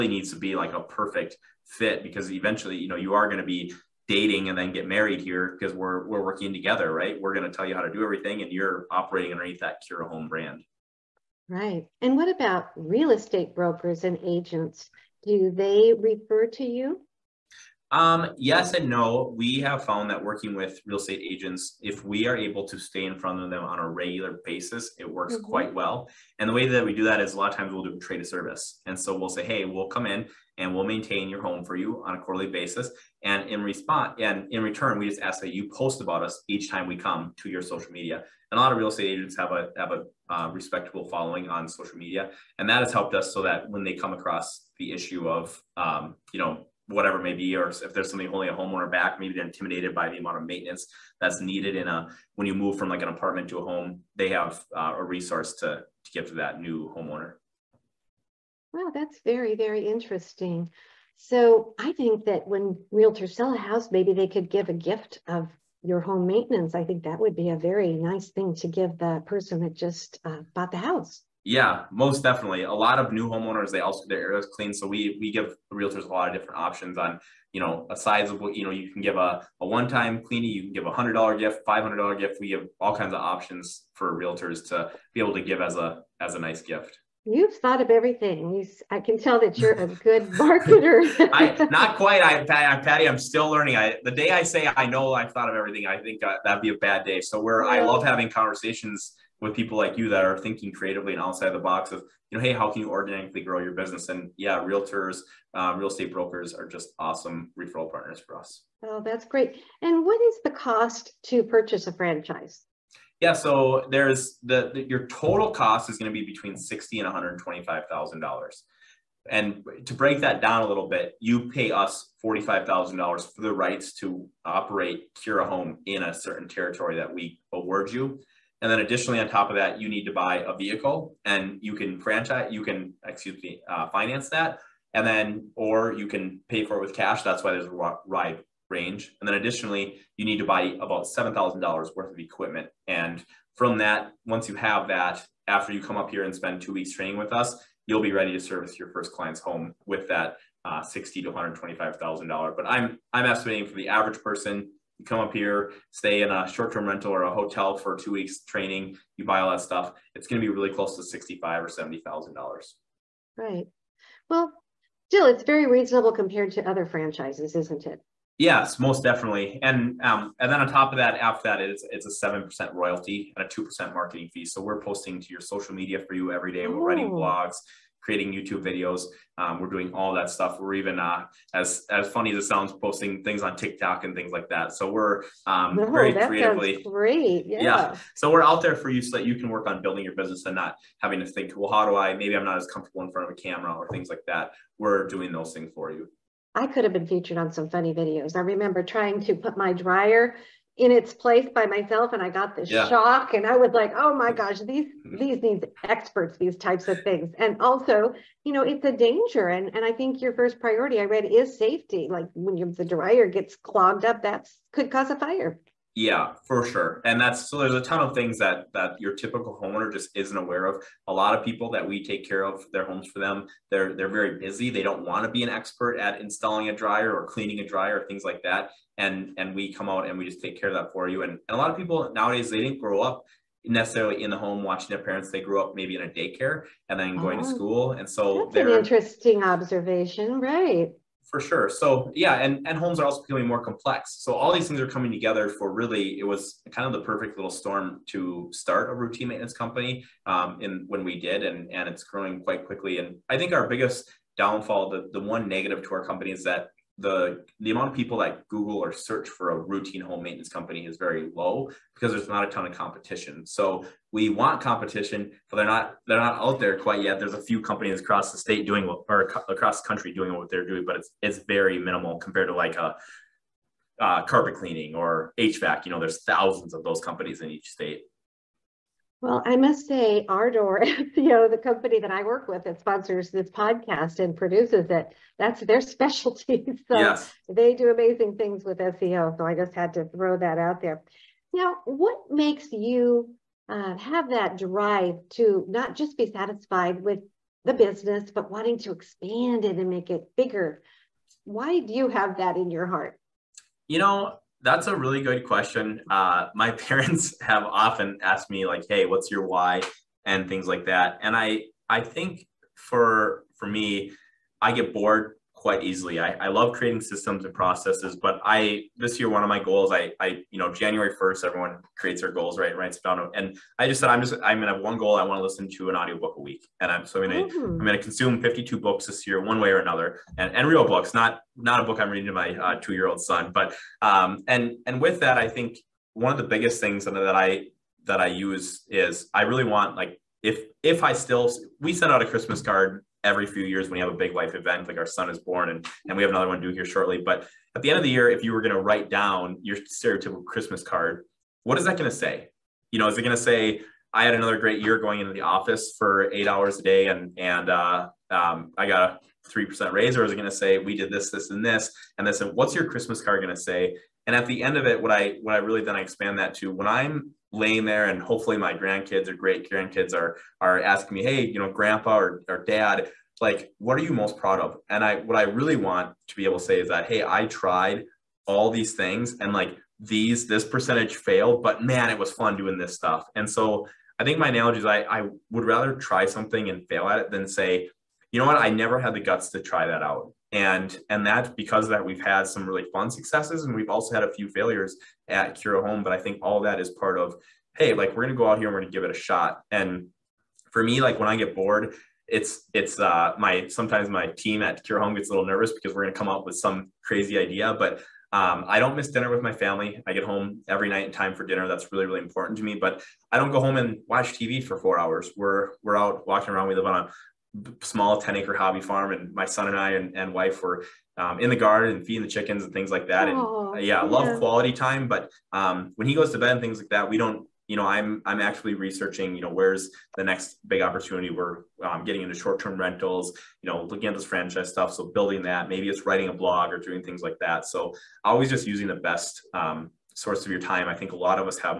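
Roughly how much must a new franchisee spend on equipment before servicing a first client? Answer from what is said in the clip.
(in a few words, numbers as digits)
$7,000.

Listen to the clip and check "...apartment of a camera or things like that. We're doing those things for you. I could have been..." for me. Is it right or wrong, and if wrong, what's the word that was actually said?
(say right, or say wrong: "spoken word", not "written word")
wrong: "front", not "apartment".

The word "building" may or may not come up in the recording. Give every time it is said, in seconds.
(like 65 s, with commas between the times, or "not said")
189 s, 435 s.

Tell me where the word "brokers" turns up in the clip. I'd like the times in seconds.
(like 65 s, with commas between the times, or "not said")
13 s, 106 s.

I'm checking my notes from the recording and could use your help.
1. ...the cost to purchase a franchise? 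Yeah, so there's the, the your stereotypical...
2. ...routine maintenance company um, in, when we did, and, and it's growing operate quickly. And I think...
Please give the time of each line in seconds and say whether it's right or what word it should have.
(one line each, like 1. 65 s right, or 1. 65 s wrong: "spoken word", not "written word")
1. 110 s wrong: "total", not "stereotypical"
2. 248 s wrong: "quite", not "operate".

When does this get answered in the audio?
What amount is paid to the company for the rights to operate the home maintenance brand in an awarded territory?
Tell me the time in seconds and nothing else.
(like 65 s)
122 s.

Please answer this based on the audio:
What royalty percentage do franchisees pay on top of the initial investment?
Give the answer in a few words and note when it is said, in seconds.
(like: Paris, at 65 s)
7%, at 172 s.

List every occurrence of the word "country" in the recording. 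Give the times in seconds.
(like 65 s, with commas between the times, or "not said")
269 s.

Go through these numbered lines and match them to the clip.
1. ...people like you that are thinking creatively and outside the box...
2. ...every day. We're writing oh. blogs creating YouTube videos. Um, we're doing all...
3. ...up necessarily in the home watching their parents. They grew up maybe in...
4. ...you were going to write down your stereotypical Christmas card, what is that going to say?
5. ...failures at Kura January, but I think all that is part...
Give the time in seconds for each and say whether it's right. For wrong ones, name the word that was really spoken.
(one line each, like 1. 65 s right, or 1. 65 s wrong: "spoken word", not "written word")
1. 99 s right
2. 176 s right
3. 233 s right
4. 348 s right
5. 394 s wrong: "Home", not "January".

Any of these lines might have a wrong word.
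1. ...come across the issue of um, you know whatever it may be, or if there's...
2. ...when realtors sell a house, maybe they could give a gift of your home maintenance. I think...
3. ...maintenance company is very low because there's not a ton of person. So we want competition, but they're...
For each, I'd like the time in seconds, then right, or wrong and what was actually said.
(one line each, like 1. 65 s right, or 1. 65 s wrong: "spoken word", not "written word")
1. 43 s right
2. 62 s right
3. 260 s wrong: "competition", not "person".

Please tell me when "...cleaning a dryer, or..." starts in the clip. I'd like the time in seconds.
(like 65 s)
227 s.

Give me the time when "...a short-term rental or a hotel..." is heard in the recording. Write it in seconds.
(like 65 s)
156 s.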